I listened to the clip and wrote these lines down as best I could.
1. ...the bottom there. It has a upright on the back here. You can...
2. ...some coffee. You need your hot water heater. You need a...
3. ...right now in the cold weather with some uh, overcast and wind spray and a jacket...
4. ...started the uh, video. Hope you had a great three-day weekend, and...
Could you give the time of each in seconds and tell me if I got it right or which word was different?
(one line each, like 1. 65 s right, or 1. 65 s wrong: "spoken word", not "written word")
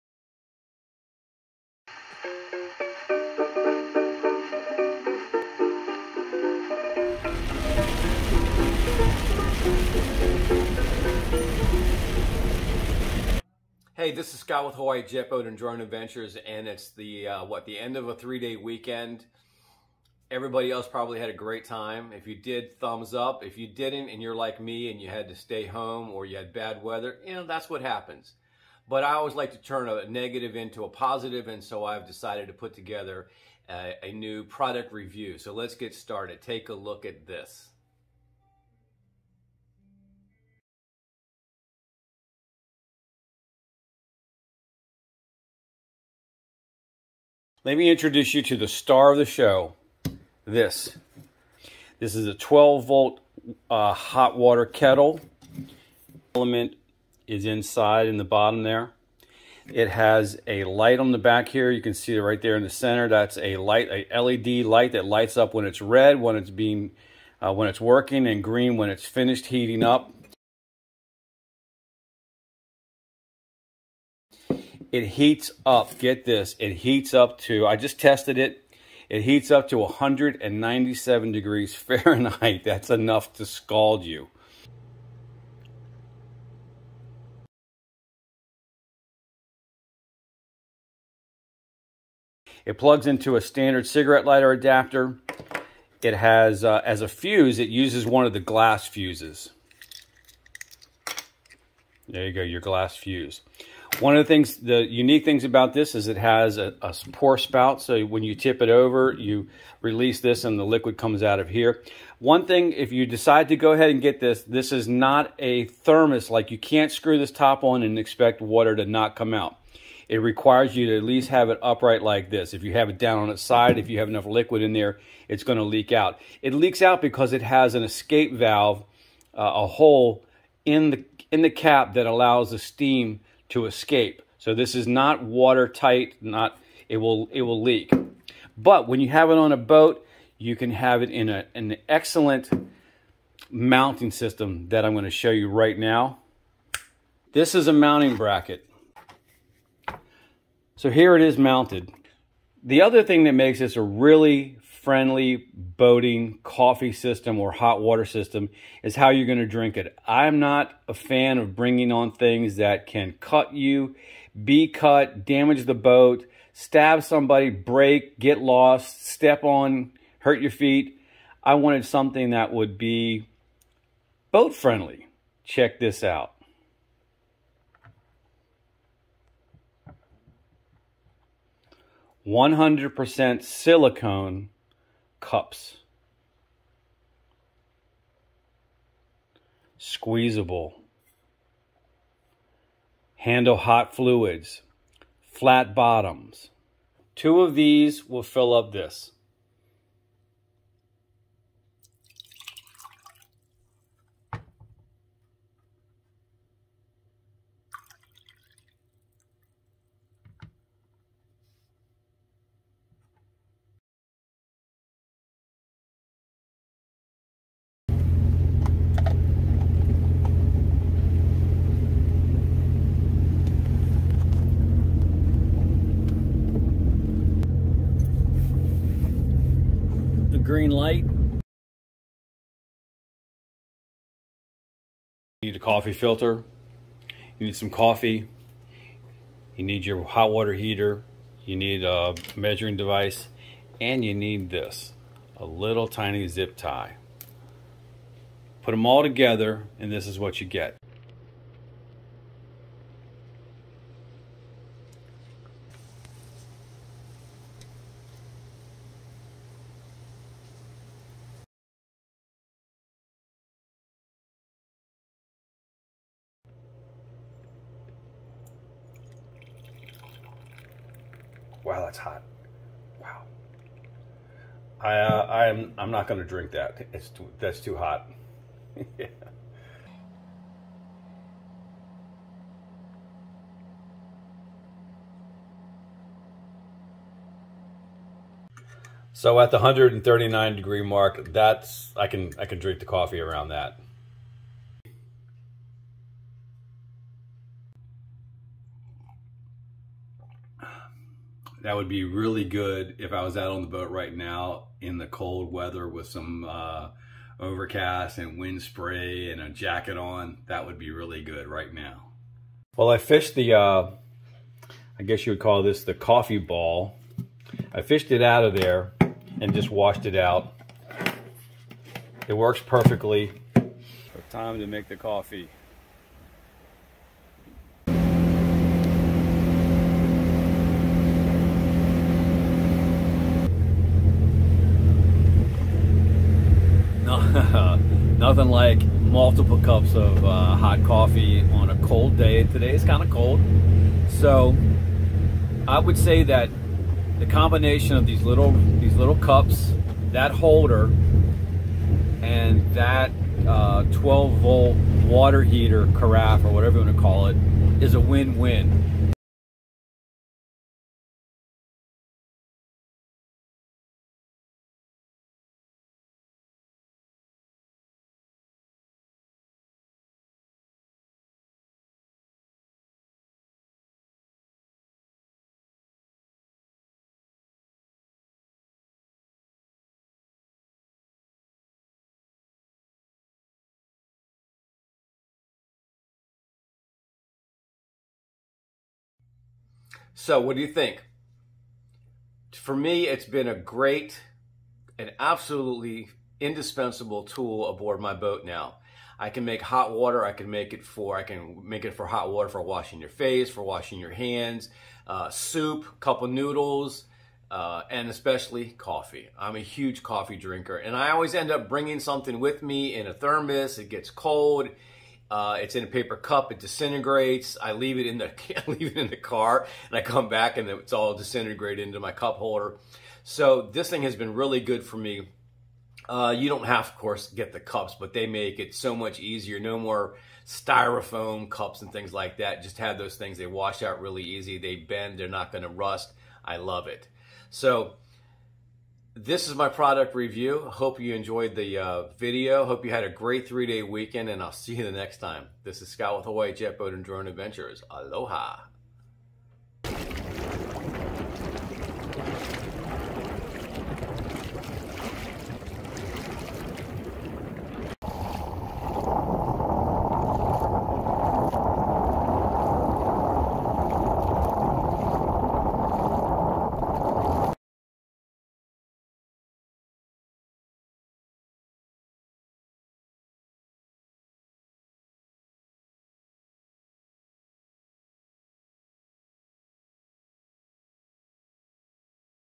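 1. 58 s wrong: "light", not "upright"
2. 237 s right
3. 303 s right
4. 441 s wrong: "enjoyed", not "started".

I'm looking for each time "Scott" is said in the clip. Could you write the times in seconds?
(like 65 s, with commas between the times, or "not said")
14 s, 445 s.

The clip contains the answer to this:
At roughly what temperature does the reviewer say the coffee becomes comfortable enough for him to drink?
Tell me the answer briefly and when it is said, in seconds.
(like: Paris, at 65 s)
139 degrees, at 289 s.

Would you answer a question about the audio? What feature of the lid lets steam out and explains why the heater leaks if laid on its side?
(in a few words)
escape valve.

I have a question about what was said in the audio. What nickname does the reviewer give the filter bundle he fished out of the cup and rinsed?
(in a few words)
coffee ball.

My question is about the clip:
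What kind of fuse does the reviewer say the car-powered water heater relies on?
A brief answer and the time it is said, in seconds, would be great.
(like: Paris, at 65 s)
glass fuse, at 98 s.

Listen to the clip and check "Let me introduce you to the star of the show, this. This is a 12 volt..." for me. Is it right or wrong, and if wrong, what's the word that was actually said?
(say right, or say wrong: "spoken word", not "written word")
right.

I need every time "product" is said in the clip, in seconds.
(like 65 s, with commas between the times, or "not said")
34 s, 439 s.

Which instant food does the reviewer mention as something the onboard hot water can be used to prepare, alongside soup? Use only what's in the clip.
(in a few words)
cup of noodles.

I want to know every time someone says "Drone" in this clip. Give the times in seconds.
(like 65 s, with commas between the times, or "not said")
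15 s, 447 s.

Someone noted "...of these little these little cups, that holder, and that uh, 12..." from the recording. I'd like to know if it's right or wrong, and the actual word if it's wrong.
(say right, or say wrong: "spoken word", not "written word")
right.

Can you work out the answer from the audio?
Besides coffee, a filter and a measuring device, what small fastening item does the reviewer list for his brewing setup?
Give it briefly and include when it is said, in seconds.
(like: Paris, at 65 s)
zip tie, at 246 s.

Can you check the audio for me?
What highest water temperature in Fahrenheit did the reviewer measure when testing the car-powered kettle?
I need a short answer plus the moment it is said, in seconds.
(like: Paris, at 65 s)
197 degrees, at 79 s.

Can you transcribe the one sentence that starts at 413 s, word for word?
It gets cold, uh, it's in a paper cup.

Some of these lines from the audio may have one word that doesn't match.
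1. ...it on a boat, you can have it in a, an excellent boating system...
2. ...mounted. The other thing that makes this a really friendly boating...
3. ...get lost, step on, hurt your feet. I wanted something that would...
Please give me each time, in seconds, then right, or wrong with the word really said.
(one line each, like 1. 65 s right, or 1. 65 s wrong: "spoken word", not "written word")
1. 139 s wrong: "mounting", not "boating"
2. 151 s right
3. 168 s right.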